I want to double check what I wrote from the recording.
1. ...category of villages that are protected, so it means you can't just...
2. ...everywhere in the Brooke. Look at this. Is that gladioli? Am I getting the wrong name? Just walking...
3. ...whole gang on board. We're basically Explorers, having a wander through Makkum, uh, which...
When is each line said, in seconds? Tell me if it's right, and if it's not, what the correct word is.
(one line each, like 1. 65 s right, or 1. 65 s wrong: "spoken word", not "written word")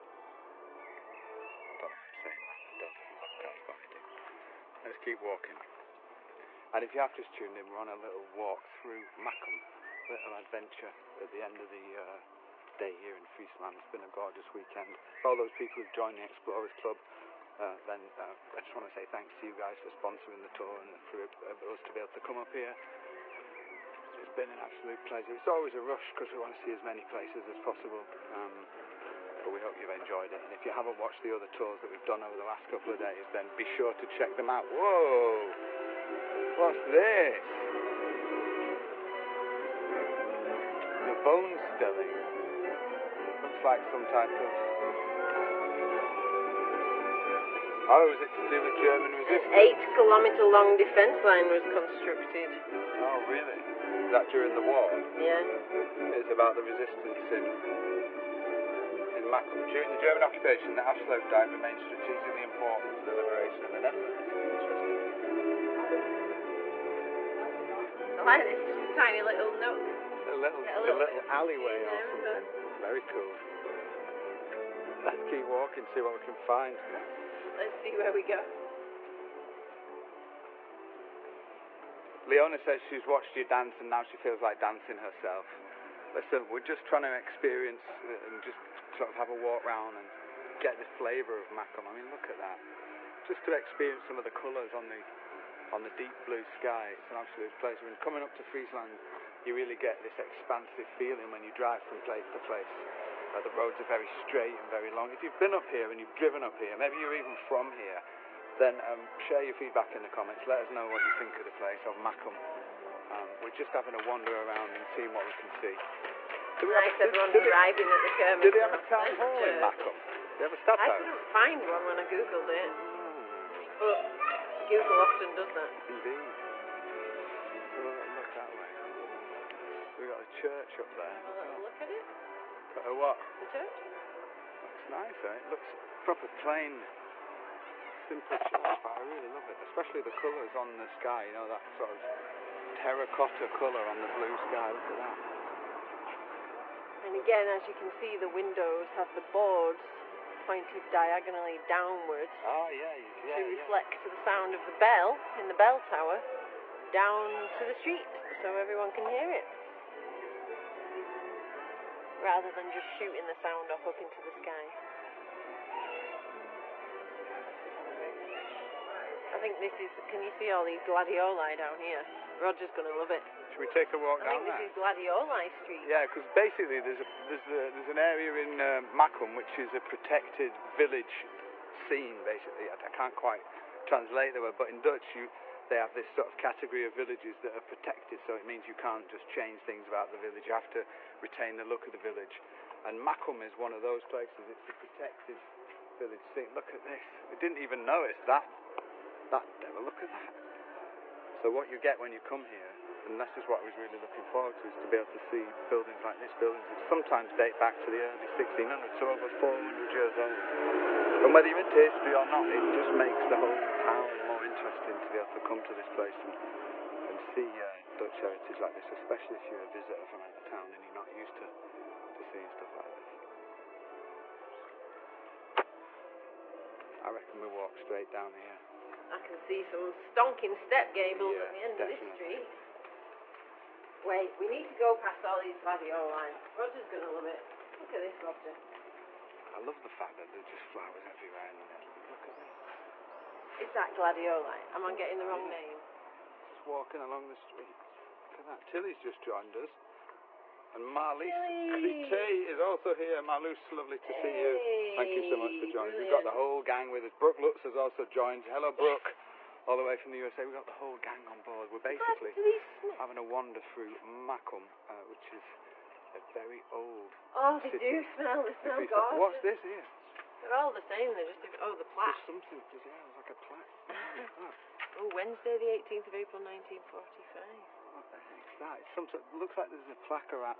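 1. 186 s right
2. 241 s wrong: "Netherlands", not "Brooke"
3. 260 s wrong: "God", not "Explorers".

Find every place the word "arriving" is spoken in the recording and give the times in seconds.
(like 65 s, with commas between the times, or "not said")
117 s.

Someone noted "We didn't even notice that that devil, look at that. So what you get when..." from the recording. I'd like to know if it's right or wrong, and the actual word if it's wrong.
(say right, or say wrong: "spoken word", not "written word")
right.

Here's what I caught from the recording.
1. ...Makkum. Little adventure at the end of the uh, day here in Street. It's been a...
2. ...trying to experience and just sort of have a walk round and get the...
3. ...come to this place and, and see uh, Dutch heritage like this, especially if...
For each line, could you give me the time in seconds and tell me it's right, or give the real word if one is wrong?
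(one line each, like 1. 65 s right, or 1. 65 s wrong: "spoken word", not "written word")
1. 9 s wrong: "Friesland", not "Street"
2. 86 s right
3. 215 s right.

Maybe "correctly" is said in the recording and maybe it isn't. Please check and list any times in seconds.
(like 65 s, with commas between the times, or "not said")
not said.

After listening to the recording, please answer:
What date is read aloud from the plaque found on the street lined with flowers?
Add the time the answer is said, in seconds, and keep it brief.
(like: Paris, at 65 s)
Wednesday, 18 April 1945, at 275 s.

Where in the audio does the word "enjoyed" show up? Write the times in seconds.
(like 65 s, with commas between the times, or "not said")
29 s.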